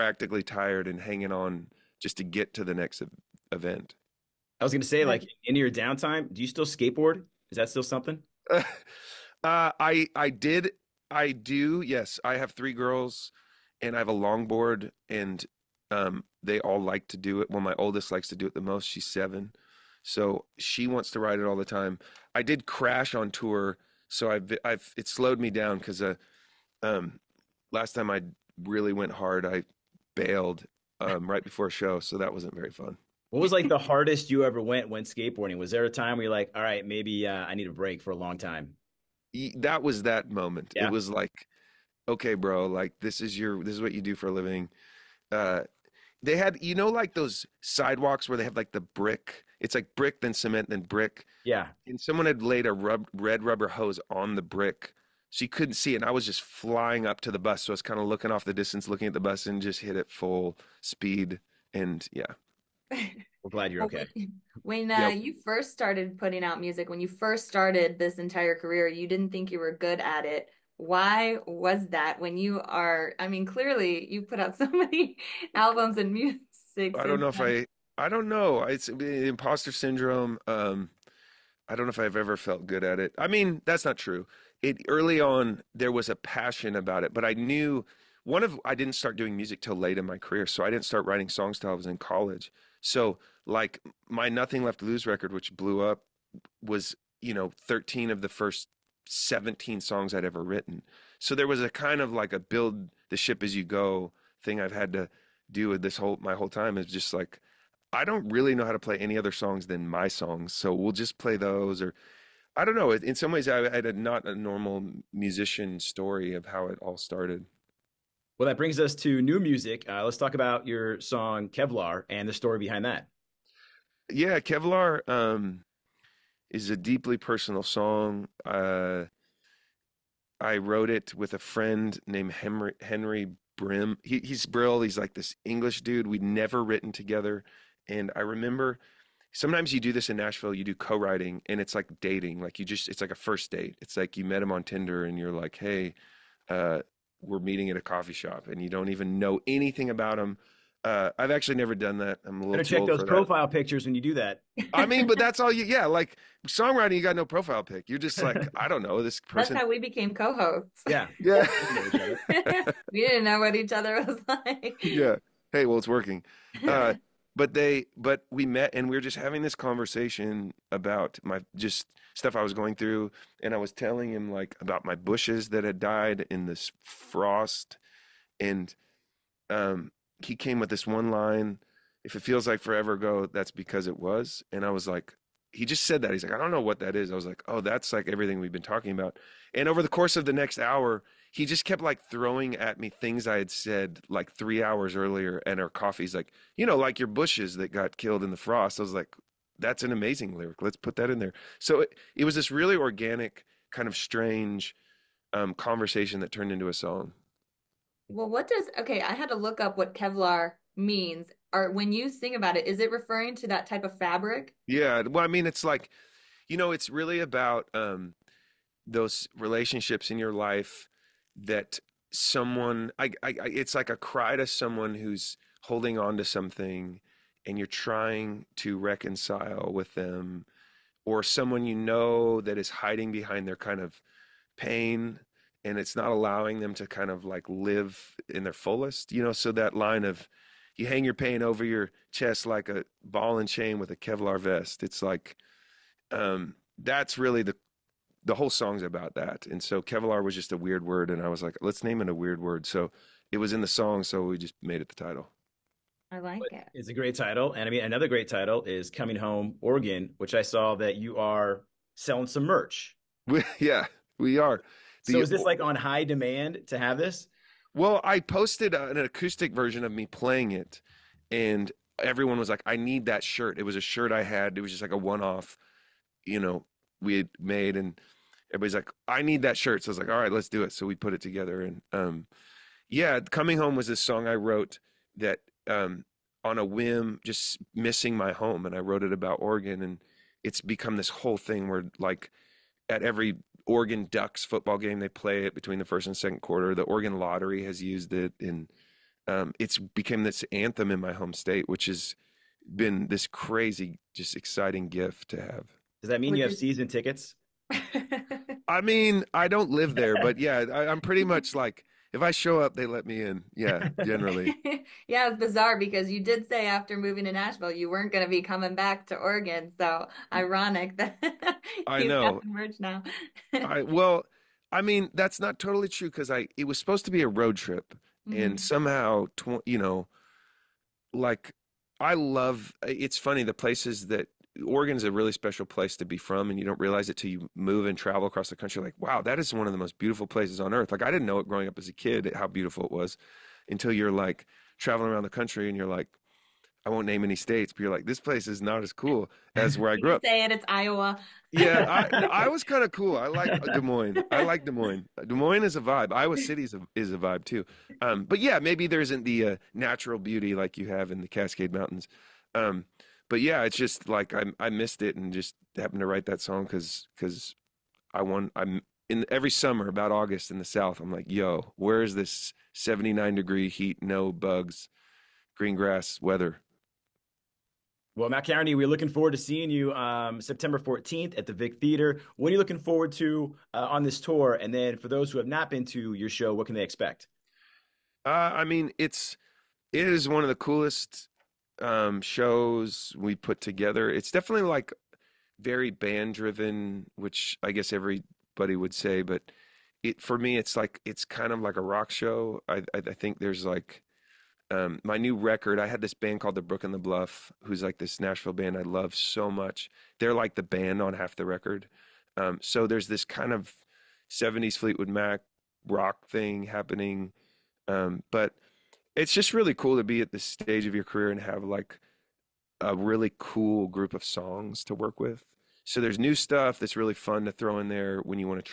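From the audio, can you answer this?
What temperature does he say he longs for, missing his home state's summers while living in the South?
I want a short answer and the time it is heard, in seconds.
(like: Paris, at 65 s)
79, at 372 s.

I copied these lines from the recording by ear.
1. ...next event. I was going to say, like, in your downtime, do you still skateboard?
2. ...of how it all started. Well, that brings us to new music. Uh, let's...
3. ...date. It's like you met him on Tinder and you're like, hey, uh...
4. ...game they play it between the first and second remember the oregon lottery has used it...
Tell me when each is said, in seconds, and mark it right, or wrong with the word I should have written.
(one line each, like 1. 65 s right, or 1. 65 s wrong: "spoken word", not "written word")
1. 2 s right
2. 116 s right
3. 143 s right
4. 294 s wrong: "quarter", not "remember".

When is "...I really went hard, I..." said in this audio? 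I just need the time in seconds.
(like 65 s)
28 s.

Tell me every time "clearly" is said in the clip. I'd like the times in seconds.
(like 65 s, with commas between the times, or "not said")
73 s.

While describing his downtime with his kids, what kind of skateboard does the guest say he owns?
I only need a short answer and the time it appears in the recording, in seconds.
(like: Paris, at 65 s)
Longboard, at 14 s.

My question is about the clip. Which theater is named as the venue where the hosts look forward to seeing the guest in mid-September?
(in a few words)
Vic Theater.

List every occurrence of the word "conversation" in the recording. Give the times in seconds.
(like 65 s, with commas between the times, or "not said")
169 s, 205 s.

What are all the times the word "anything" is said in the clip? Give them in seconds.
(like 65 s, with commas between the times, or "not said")
149 s.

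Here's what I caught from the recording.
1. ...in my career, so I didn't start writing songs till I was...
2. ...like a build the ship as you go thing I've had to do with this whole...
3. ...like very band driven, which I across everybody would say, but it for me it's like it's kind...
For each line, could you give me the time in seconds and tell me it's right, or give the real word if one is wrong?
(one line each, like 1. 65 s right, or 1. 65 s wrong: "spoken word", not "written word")
1. 89 s right
2. 102 s right
3. 394 s wrong: "guess", not "across".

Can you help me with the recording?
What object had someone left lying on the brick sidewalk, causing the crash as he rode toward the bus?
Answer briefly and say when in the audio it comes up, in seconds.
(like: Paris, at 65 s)
Red rubber hose, at 53 s.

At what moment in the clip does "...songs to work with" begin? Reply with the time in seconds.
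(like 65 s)
424 s.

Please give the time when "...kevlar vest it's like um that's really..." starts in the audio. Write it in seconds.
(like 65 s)
243 s.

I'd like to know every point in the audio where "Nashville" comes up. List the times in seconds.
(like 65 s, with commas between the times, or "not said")
140 s, 317 s, 408 s.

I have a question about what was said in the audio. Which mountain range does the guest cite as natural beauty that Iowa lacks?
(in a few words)
Cascade Mountains.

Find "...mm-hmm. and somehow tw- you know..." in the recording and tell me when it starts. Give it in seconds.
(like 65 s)
328 s.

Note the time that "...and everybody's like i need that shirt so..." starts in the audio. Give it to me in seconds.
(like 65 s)
277 s.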